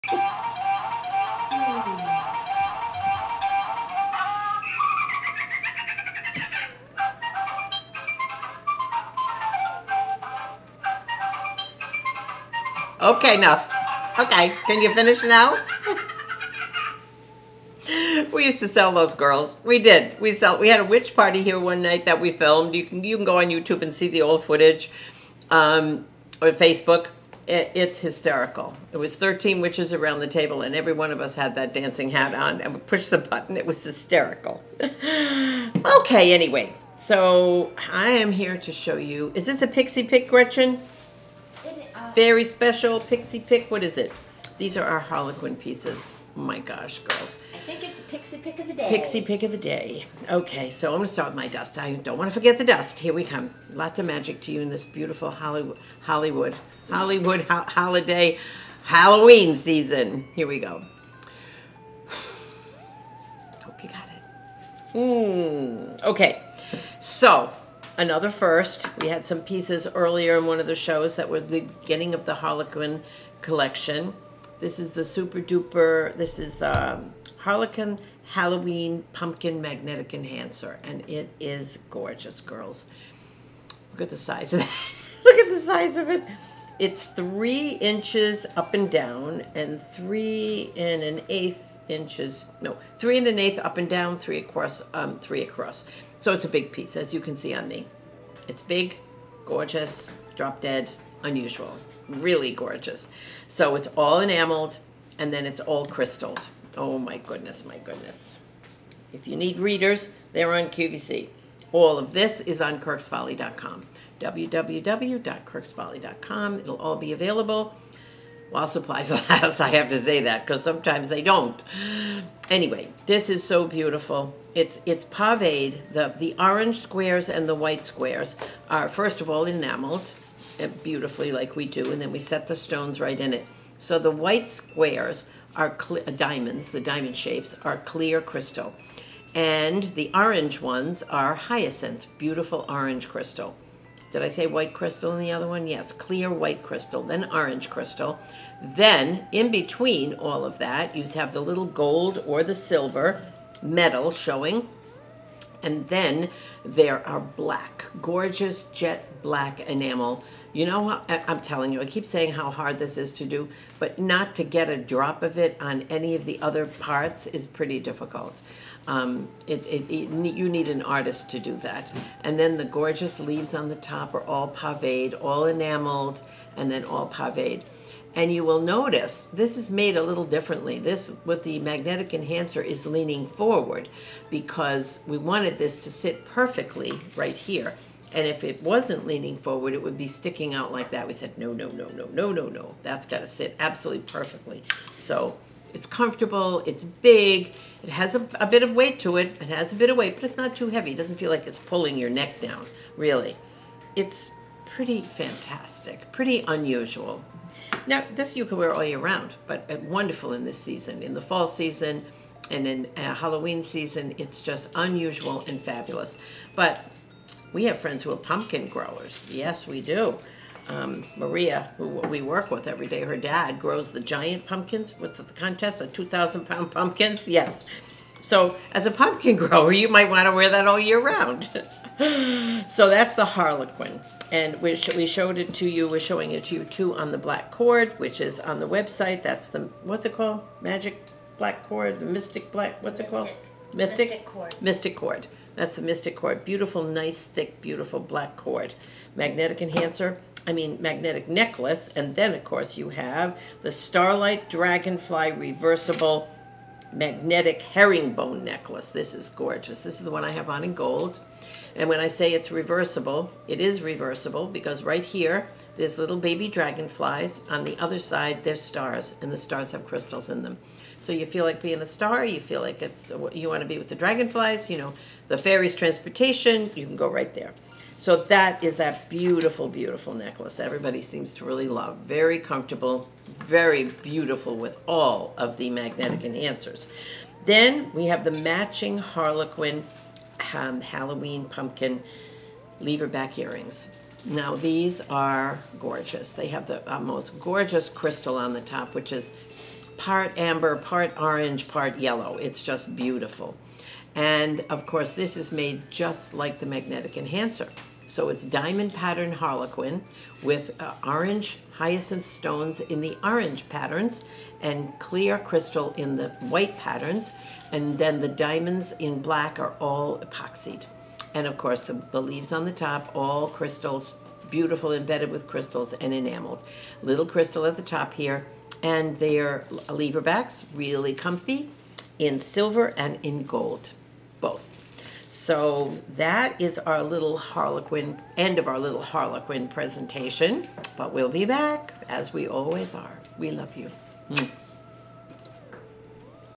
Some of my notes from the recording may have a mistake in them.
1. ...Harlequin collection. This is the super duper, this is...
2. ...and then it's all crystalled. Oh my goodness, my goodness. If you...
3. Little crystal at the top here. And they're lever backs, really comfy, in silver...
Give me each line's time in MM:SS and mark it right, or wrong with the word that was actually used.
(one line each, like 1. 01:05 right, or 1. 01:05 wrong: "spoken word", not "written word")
1. 01:12 right
2. 01:45 right
3. 05:27 right.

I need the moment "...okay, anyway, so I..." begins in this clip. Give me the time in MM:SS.
00:34.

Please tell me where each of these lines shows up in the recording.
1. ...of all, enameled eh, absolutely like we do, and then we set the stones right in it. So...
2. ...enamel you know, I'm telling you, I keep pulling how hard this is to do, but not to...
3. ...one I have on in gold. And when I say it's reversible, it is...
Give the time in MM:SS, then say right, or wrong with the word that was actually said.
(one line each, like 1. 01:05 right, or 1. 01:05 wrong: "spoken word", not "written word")
1. 02:09 wrong: "beautifully", not "absolutely"
2. 02:39 wrong: "saying", not "pulling"
3. 04:20 right.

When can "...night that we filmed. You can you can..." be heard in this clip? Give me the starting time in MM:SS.
00:21.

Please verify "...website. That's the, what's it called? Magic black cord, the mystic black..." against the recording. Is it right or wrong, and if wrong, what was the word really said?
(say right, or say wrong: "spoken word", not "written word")
right.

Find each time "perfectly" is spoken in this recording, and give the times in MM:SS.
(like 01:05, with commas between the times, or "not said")
03:06, 03:14.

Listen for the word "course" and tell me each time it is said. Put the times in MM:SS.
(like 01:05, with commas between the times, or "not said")
04:12, 05:04, 05:21.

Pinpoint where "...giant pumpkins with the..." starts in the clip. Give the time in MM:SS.
03:43.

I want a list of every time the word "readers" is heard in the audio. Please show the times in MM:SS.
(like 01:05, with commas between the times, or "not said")
01:49.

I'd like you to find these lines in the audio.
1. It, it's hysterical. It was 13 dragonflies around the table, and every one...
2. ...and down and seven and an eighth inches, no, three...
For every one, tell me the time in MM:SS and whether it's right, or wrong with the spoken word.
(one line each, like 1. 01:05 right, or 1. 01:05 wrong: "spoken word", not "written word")
1. 00:27 wrong: "witches", not "dragonflies"
2. 01:28 wrong: "three", not "seven".